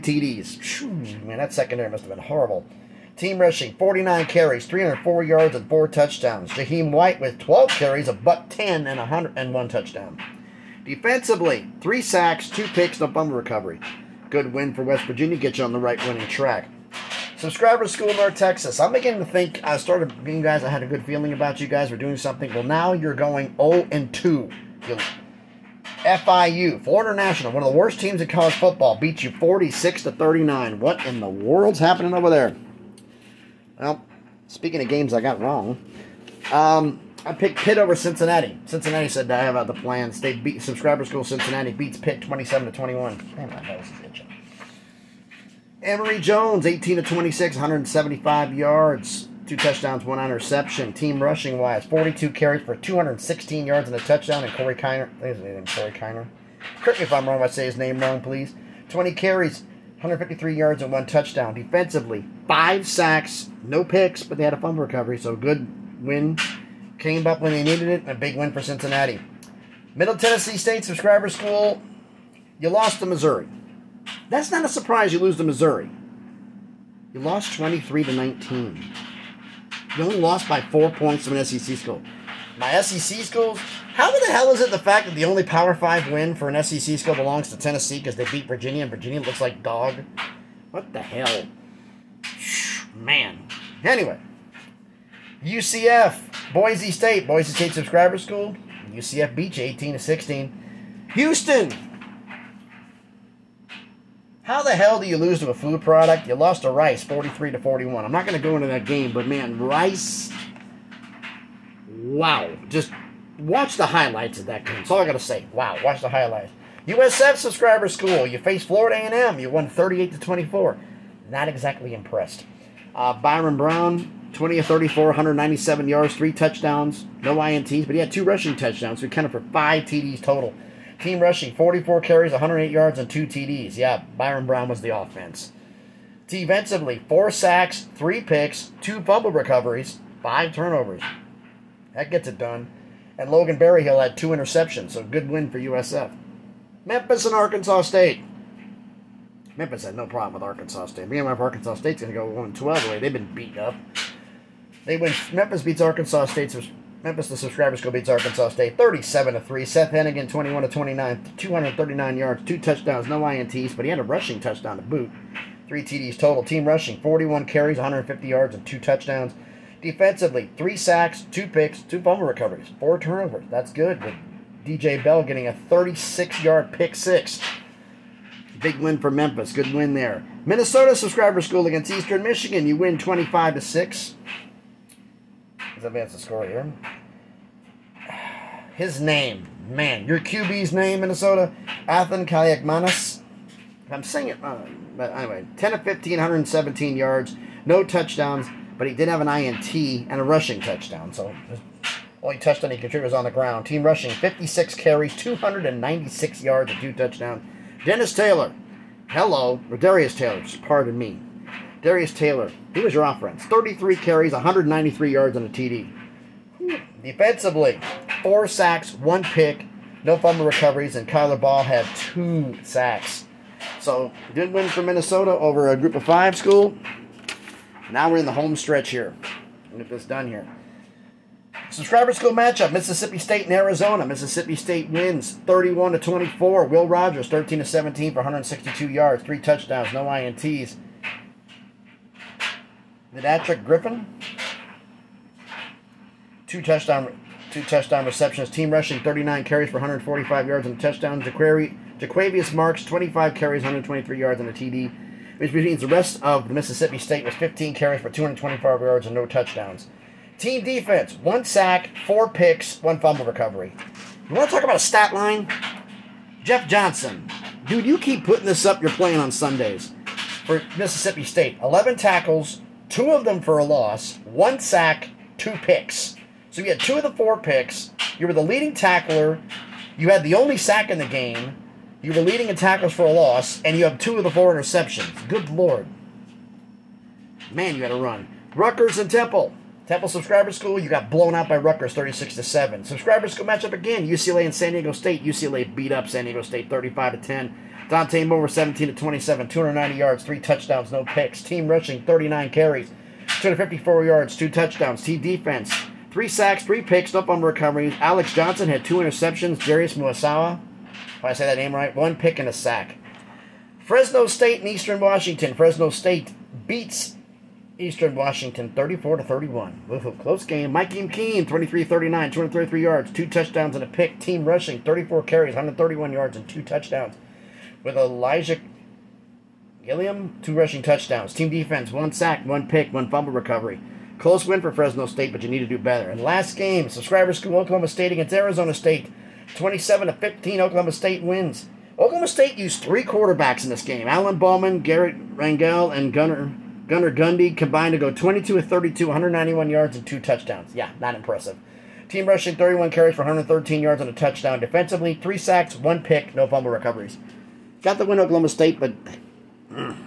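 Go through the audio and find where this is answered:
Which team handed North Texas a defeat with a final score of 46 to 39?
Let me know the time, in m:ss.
0:26.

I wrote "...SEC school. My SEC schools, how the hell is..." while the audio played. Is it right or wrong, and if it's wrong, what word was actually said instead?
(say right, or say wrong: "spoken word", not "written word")
right.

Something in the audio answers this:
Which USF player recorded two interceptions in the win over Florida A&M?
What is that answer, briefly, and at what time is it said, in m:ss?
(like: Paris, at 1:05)
Logan Berryhill, at 2:23.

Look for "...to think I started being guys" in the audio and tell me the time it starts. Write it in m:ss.
0:19.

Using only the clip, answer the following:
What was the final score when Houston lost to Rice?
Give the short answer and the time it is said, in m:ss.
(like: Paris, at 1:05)
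43 to 41, at 1:47.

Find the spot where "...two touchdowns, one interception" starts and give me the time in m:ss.
0:49.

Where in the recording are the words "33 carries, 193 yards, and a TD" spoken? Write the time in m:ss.
3:33.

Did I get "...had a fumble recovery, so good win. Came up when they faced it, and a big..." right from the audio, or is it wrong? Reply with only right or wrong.
wrong.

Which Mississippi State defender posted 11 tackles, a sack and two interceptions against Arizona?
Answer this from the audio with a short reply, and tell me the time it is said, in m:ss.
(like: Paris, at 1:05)
Jett Johnson, at 4:26.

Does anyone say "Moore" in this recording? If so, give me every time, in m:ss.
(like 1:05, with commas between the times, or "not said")
4:58.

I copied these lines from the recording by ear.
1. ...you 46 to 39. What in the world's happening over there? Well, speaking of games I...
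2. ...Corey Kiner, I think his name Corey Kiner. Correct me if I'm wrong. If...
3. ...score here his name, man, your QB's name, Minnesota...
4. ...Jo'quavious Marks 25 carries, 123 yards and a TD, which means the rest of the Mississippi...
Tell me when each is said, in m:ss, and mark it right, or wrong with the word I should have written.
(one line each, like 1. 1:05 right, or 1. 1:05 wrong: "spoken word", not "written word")
1. 0:29 right
2. 0:54 right
3. 3:06 right
4. 4:11 right.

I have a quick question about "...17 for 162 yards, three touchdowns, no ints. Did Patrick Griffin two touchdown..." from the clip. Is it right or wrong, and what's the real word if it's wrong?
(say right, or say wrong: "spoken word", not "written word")
right.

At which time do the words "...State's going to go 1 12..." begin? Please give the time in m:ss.
2:31.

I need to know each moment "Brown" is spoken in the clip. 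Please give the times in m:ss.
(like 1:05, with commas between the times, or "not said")
2:03, 2:14.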